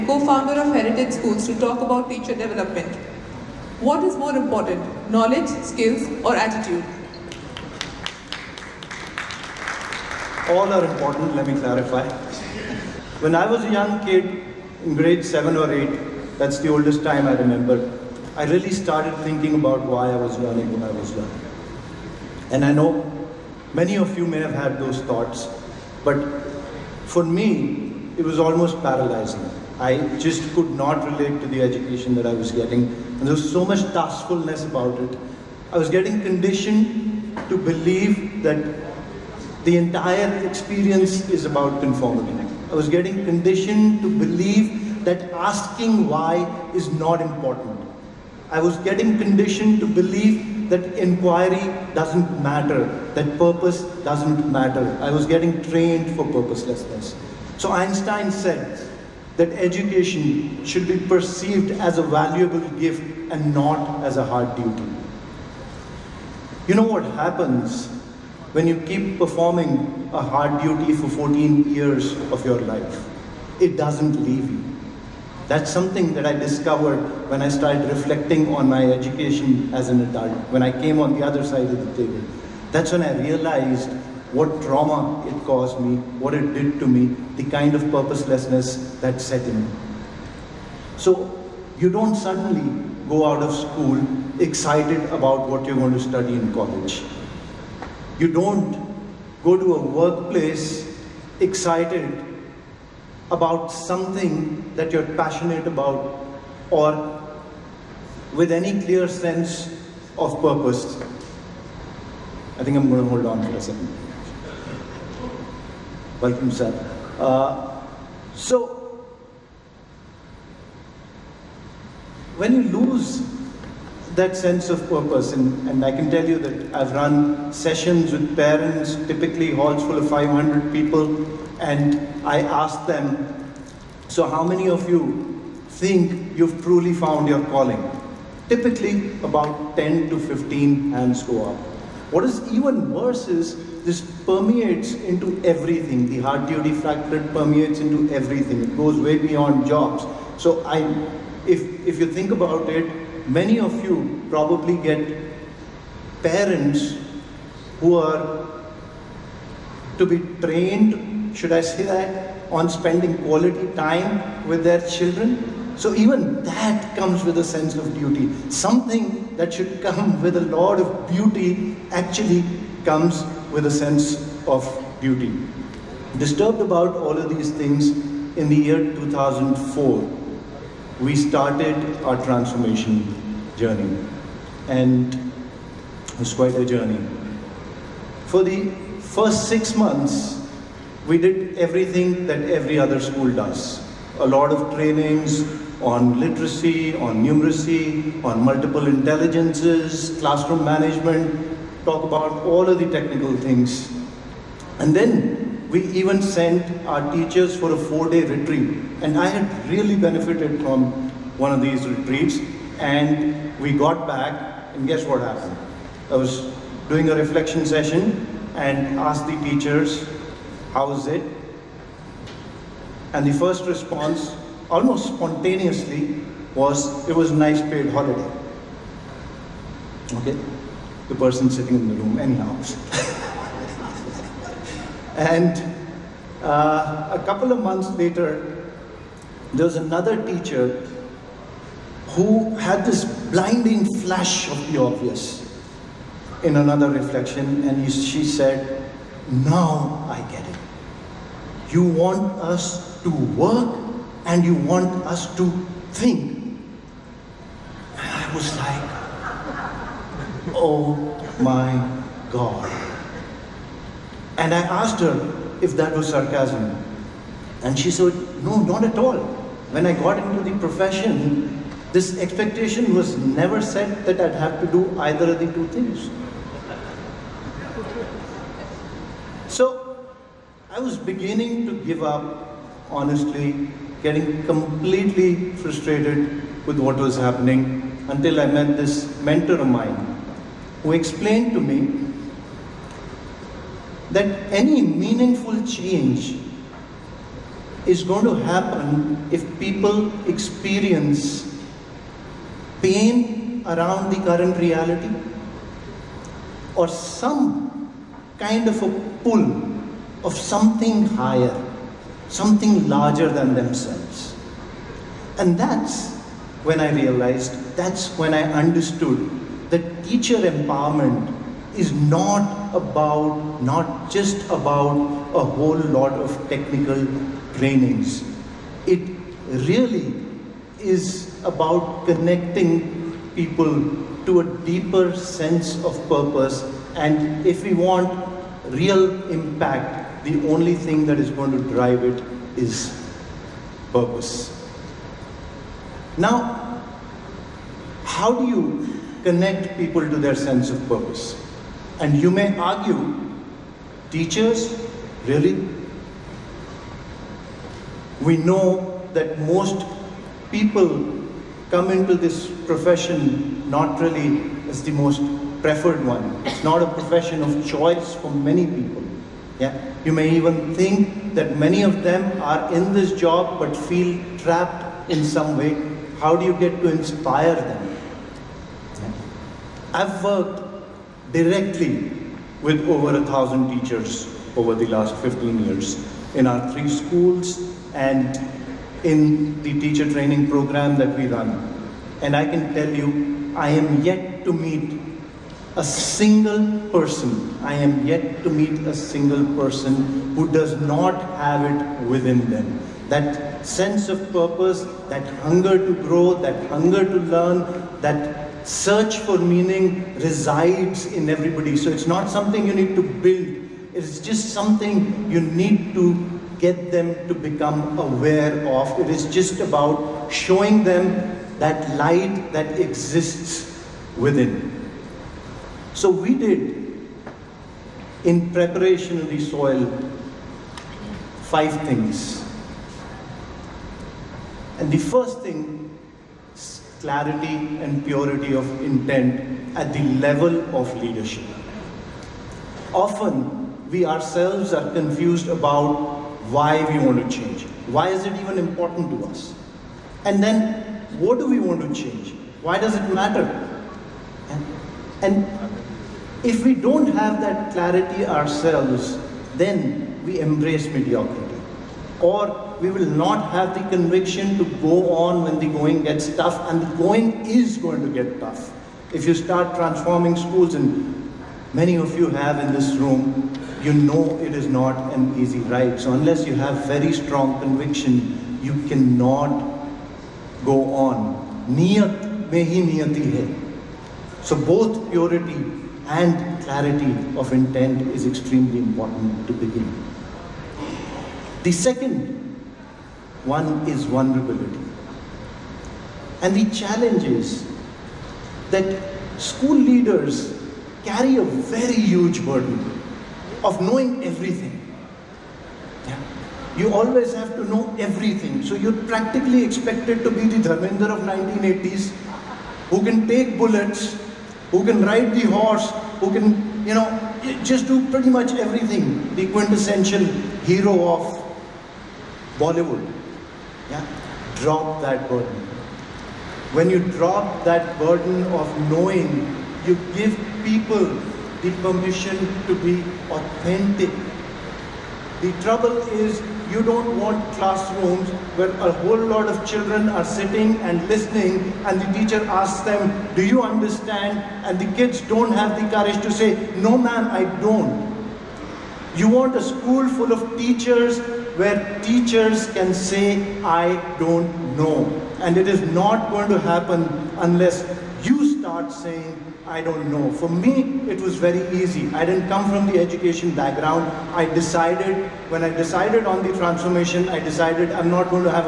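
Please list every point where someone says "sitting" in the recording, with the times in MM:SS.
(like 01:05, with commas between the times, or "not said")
03:51, 09:00.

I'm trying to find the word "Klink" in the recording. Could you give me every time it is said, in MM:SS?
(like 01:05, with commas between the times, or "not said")
not said.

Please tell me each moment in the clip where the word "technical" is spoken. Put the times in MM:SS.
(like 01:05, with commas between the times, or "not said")
03:22, 05:26.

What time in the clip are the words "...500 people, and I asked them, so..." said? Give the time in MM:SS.
02:10.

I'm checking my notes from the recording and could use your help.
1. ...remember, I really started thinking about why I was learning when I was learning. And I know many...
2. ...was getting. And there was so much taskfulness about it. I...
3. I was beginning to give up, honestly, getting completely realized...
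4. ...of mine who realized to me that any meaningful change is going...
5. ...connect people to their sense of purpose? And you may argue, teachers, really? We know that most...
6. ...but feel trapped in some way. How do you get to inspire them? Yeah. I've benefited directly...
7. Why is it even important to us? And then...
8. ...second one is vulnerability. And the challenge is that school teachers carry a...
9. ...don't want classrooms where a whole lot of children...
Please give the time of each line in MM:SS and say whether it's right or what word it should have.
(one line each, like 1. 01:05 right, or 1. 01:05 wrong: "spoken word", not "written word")
1. 00:17 right
2. 00:32 right
3. 04:40 wrong: "frustrated", not "realized"
4. 04:49 wrong: "explained", not "realized"
5. 05:49 right
6. 06:13 wrong: "worked", not "benefited"
7. 07:27 right
8. 08:11 wrong: "leaders", not "teachers"
9. 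08:56 right.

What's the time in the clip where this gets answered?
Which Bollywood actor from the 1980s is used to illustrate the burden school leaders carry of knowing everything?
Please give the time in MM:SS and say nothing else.
08:30.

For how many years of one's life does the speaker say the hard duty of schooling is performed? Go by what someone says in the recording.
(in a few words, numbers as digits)
14.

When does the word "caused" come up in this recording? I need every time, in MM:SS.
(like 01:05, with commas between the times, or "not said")
01:25.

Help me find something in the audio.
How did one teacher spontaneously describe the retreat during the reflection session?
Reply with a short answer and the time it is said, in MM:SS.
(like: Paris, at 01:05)
a nice paid holiday, at 03:47.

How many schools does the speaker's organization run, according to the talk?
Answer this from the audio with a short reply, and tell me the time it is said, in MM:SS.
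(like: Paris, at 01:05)
3, at 06:26.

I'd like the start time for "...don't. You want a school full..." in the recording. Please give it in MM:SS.
09:07.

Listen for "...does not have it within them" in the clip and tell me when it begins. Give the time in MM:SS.
06:40.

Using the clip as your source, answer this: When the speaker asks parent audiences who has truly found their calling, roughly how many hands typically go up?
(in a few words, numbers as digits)
10 to 15.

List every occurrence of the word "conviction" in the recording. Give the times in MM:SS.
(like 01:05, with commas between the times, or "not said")
07:43, 07:57.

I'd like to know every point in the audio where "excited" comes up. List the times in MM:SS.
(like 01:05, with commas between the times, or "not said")
01:34, 01:41.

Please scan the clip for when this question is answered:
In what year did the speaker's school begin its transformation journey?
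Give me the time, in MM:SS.
02:58.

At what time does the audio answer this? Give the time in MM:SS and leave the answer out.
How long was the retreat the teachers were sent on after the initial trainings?
03:27.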